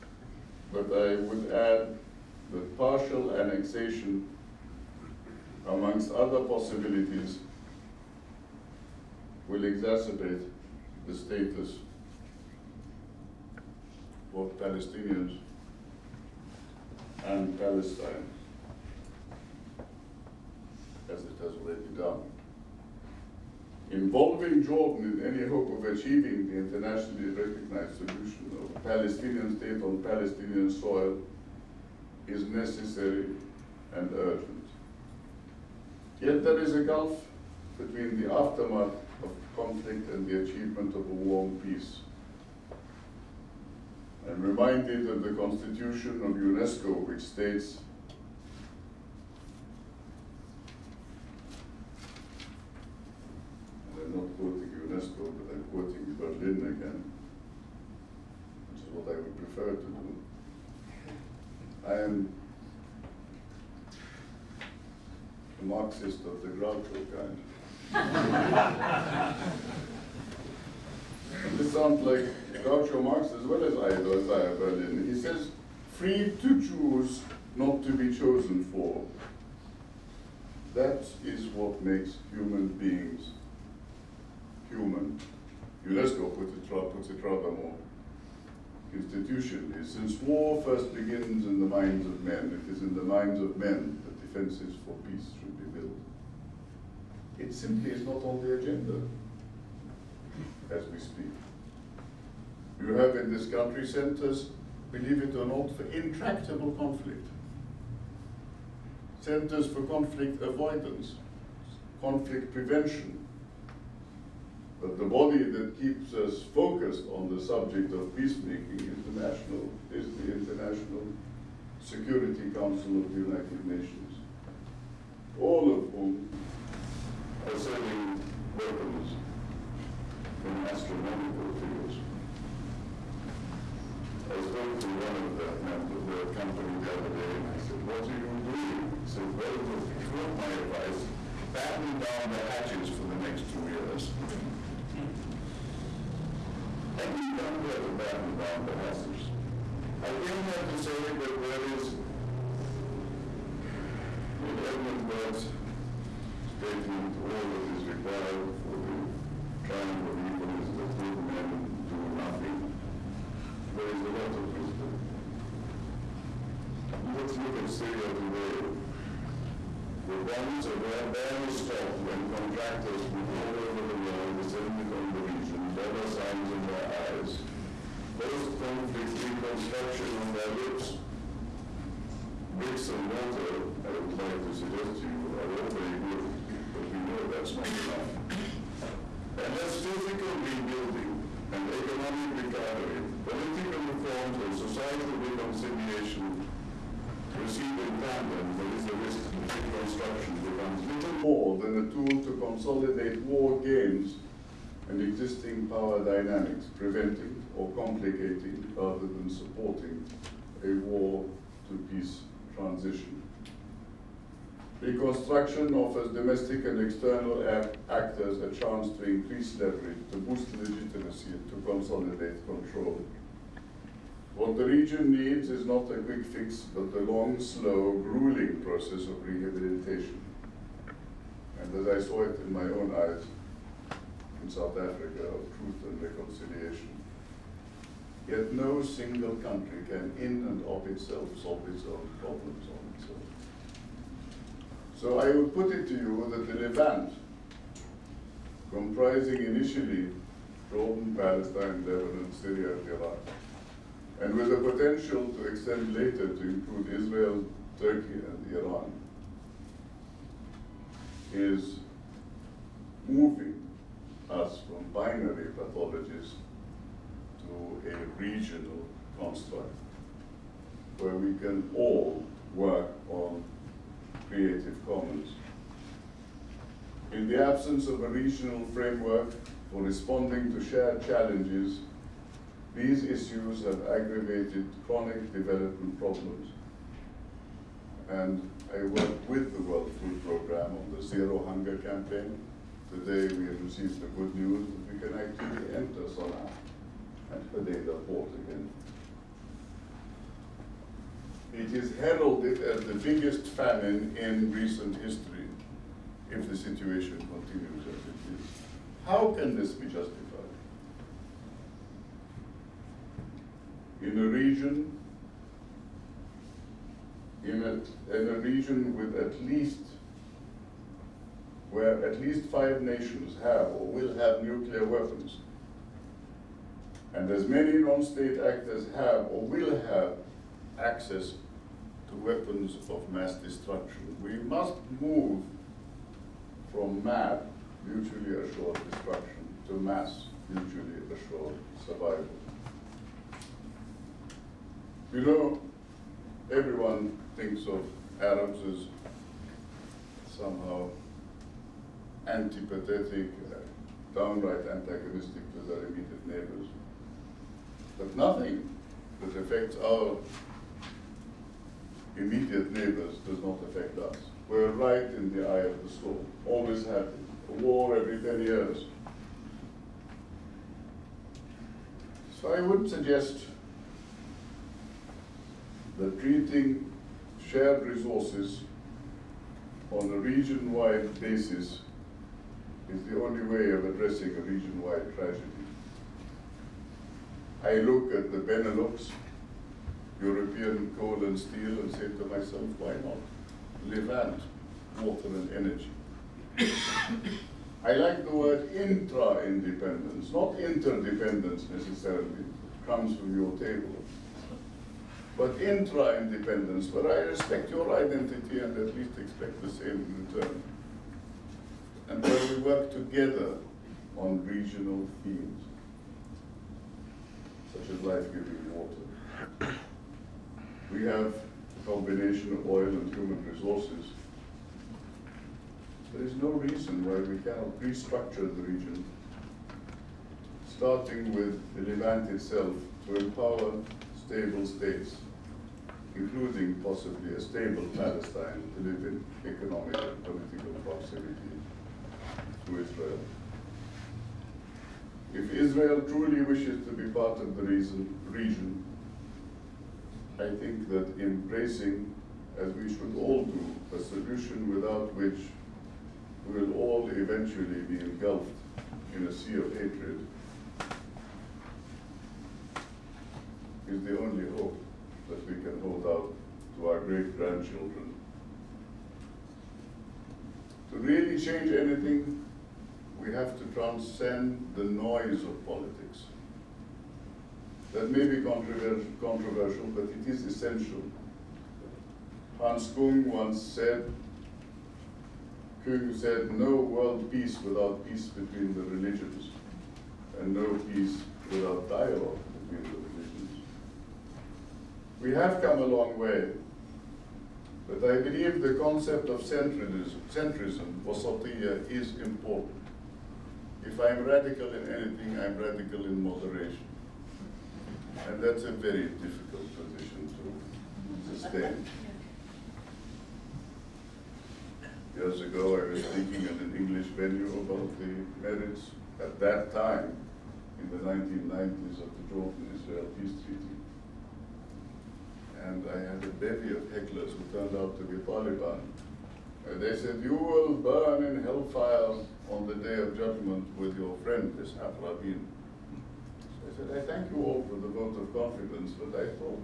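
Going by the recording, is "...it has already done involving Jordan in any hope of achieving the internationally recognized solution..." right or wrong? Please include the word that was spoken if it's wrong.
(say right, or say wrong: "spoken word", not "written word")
right.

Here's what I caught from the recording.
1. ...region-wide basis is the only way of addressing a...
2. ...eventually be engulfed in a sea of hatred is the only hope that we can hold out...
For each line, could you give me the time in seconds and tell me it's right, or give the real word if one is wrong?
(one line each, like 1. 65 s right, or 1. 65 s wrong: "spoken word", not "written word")
1. 380 s right
2. 457 s right.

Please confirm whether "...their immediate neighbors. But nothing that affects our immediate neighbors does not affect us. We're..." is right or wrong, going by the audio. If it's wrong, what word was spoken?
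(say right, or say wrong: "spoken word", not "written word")
right.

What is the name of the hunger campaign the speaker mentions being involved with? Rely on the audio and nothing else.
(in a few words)
Zero Hunger.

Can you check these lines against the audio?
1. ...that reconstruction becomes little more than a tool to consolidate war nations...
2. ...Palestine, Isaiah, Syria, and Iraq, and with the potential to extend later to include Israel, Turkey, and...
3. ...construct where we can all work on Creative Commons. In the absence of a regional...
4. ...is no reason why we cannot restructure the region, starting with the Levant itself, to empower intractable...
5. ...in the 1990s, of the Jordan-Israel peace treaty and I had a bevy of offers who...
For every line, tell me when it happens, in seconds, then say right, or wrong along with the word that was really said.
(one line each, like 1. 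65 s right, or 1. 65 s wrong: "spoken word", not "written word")
1. 199 s wrong: "gains", not "nations"
2. 251 s wrong: "Lebanon", not "Isaiah"
3. 269 s right
4. 426 s wrong: "stable", not "intractable"
5. 520 s wrong: "hecklers", not "offers".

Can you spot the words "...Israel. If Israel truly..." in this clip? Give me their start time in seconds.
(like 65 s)
442 s.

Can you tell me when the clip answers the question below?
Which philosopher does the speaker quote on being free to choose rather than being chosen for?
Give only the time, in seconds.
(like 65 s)
73 s.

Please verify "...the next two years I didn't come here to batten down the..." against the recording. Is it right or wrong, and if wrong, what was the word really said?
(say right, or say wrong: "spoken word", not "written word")
right.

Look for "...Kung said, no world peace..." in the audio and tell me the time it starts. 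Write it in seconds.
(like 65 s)
485 s.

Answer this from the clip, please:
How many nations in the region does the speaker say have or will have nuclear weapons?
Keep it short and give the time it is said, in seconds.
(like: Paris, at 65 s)
5, at 322 s.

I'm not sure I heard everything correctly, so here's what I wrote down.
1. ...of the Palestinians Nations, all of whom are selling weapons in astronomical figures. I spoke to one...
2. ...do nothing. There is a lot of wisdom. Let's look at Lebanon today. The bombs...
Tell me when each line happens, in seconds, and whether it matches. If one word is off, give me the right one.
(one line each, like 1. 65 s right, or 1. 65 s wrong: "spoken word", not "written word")
1. 122 s wrong: "United", not "Palestinians"
2. 161 s wrong: "Syria", not "Lebanon".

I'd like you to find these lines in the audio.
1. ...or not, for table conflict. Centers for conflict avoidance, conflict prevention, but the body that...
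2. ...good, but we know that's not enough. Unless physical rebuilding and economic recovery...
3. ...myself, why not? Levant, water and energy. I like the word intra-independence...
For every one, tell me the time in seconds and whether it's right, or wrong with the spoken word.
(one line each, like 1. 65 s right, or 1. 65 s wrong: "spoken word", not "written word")
1. 105 s wrong: "intractable", not "table"
2. 185 s right
3. 392 s right.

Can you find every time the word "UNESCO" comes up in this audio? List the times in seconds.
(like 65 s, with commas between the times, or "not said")
46 s, 54 s, 85 s.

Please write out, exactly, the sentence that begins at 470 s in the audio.
To really change anything, we have to transcend the noise of politics.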